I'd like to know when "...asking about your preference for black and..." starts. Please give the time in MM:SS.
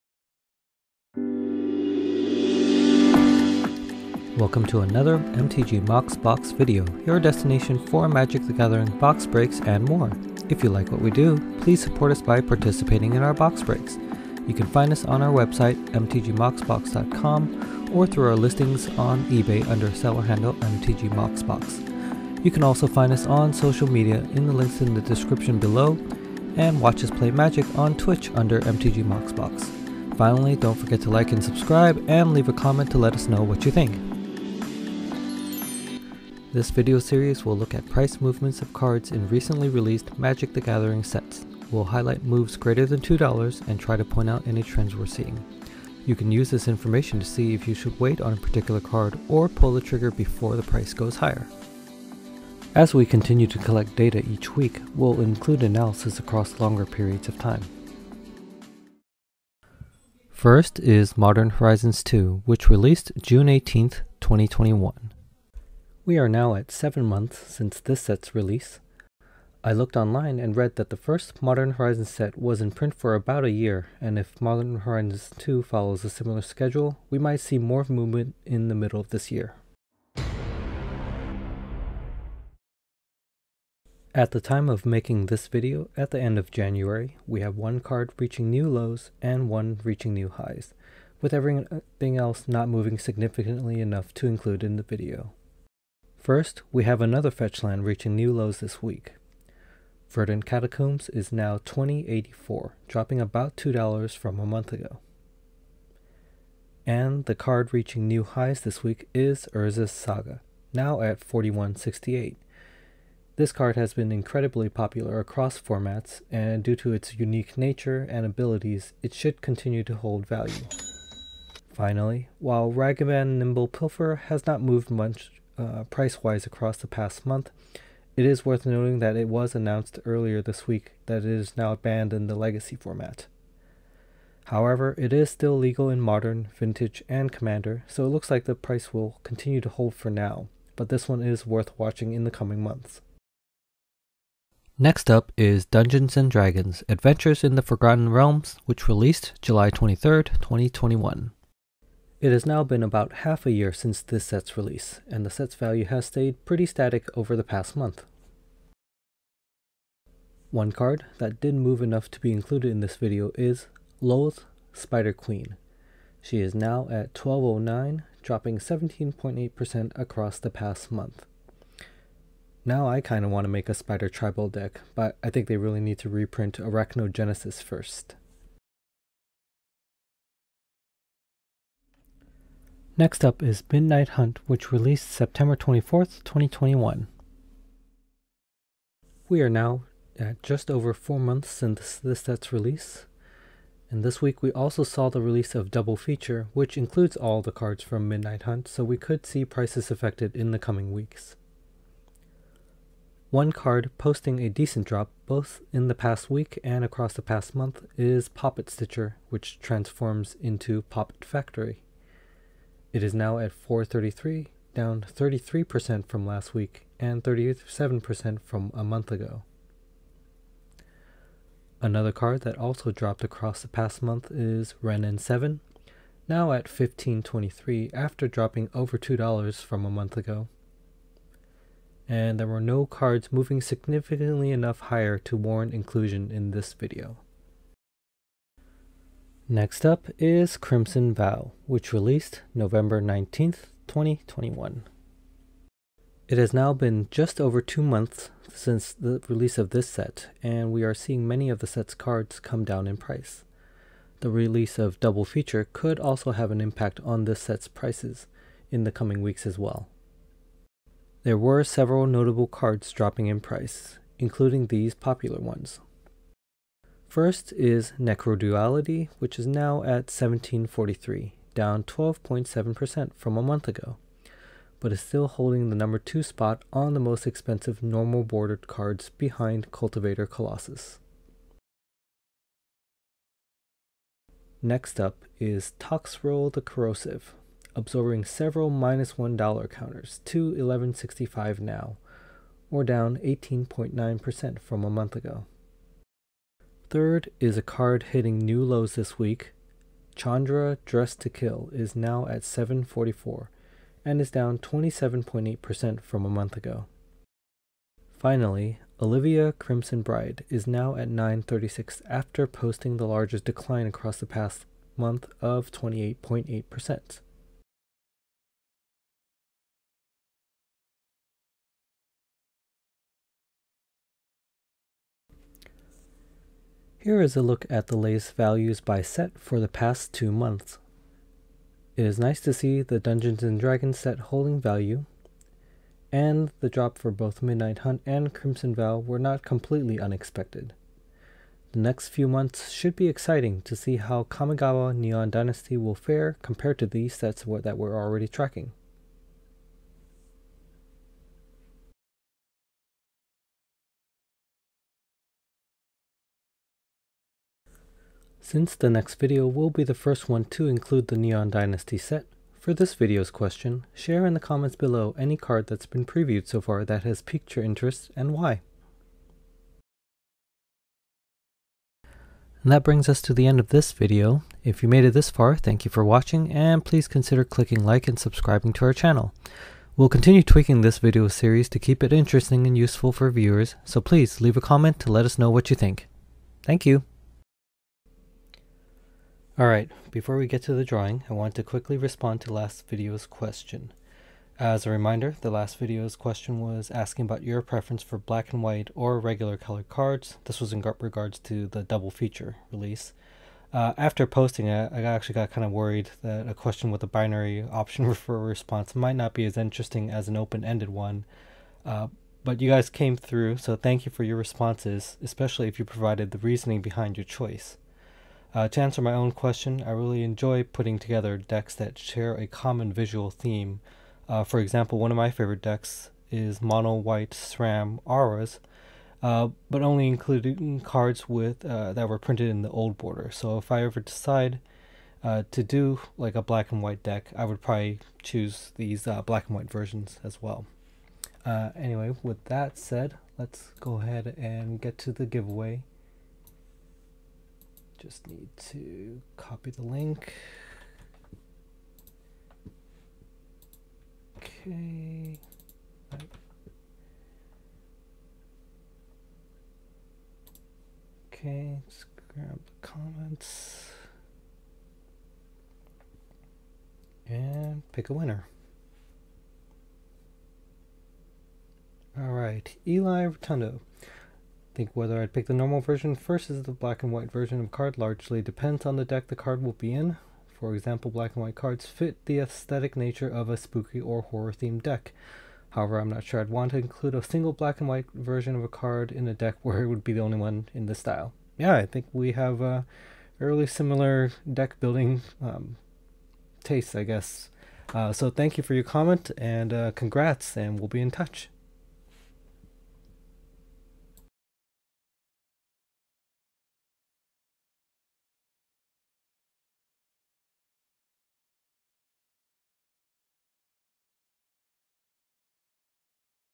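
06:36.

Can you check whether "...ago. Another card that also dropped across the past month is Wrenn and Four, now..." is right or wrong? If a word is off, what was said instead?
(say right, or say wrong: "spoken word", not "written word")
wrong: "Seven", not "Four".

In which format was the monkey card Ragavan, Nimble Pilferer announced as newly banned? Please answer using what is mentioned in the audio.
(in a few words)
Legacy.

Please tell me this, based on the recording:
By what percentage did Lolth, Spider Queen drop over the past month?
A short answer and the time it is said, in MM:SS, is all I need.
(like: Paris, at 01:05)
17.8%, at 02:48.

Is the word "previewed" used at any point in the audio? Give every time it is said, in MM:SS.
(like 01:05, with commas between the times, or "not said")
06:06.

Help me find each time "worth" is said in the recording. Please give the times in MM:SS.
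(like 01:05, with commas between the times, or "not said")
02:08, 02:21.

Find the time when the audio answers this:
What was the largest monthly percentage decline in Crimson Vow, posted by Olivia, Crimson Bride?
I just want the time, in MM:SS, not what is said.
05:15.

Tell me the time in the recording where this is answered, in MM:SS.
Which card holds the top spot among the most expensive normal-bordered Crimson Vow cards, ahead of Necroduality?
04:39.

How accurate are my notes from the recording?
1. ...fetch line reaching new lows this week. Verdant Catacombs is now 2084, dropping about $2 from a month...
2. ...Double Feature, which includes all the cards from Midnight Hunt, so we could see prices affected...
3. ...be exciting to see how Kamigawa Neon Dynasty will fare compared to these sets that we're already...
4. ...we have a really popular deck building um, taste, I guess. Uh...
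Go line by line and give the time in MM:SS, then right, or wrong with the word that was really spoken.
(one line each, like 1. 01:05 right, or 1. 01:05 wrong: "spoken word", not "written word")
1. 01:37 right
2. 03:15 right
3. 05:42 right
4. 08:12 wrong: "similar", not "popular".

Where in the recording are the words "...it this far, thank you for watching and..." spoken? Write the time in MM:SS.
06:15.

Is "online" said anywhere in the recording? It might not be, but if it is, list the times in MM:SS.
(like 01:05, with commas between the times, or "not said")
01:09.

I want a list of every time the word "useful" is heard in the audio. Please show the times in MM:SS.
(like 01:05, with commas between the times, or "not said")
06:22.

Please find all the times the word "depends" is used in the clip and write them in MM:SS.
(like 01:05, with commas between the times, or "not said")
07:58.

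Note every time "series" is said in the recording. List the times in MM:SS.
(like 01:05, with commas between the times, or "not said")
00:36, 06:21.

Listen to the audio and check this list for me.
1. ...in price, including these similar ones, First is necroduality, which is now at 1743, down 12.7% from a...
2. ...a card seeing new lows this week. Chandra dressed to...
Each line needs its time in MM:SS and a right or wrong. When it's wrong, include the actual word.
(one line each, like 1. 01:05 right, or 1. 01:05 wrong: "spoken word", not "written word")
1. 04:23 wrong: "popular", not "similar"
2. 04:57 wrong: "hitting", not "seeing".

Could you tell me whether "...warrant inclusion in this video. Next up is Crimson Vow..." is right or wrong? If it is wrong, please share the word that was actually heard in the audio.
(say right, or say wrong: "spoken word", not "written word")
right.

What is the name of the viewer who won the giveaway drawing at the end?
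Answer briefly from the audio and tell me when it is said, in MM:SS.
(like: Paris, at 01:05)
Eli Rotundo, at 07:52.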